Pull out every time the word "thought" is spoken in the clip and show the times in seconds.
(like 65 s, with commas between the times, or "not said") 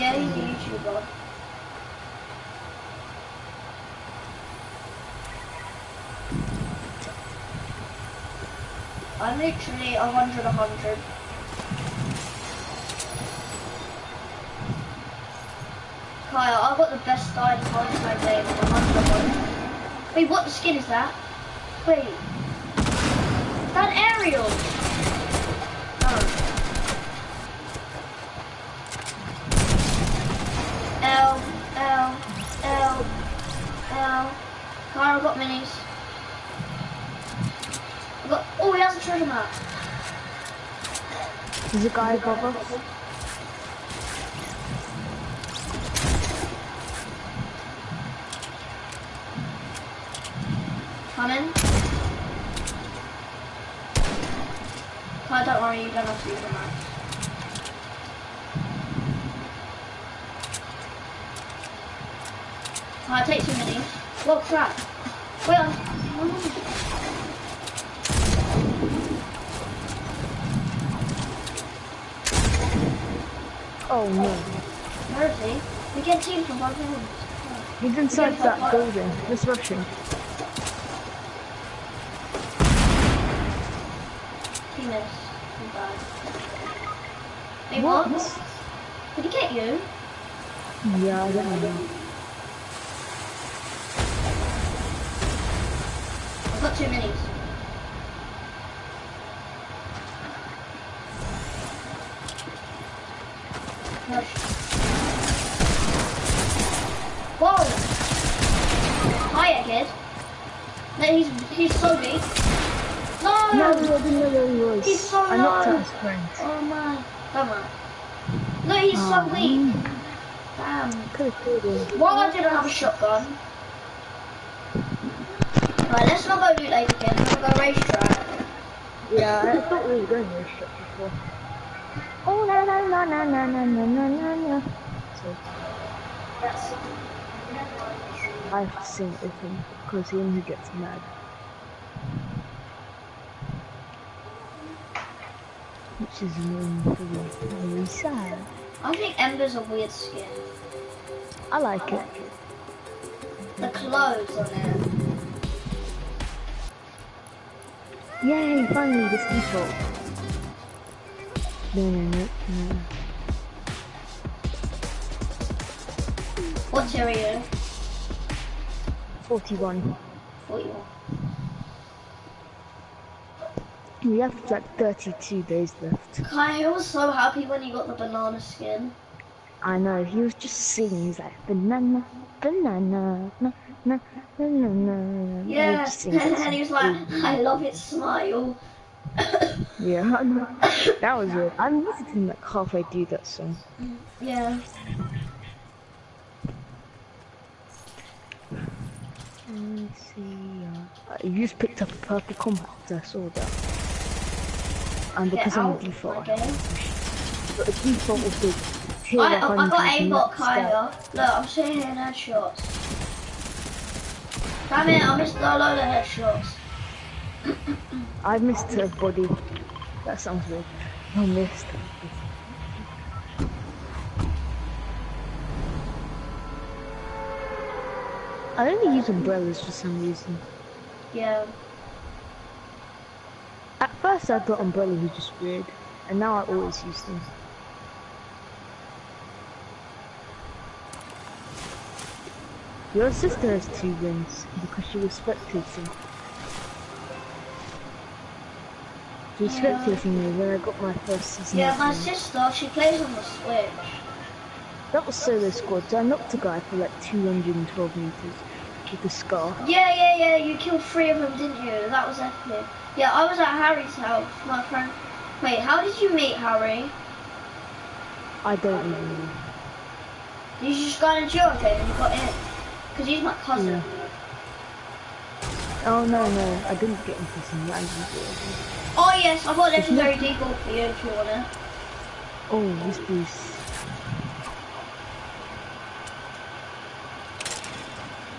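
129 s, 234 s.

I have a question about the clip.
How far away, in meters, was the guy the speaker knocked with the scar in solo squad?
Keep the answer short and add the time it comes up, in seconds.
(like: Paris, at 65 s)
212 meters, at 257 s.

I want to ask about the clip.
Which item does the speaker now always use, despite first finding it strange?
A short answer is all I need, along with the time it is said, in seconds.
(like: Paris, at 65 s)
Umbrellas, at 229 s.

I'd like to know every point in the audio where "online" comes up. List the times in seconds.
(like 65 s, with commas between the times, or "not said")
not said.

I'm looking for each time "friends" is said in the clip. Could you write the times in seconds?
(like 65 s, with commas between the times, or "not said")
116 s, 264 s.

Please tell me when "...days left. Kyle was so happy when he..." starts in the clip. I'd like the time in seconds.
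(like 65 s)
175 s.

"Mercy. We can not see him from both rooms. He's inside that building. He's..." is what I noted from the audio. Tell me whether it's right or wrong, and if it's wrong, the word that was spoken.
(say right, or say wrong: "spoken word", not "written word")
right.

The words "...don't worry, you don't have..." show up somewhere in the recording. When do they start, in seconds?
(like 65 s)
55 s.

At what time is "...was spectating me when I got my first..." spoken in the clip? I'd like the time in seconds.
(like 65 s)
249 s.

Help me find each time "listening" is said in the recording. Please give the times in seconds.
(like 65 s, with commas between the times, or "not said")
191 s.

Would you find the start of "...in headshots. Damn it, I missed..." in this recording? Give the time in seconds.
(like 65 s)
211 s.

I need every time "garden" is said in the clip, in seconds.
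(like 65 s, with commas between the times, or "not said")
not said.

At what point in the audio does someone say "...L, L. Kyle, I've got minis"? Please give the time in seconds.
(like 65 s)
33 s.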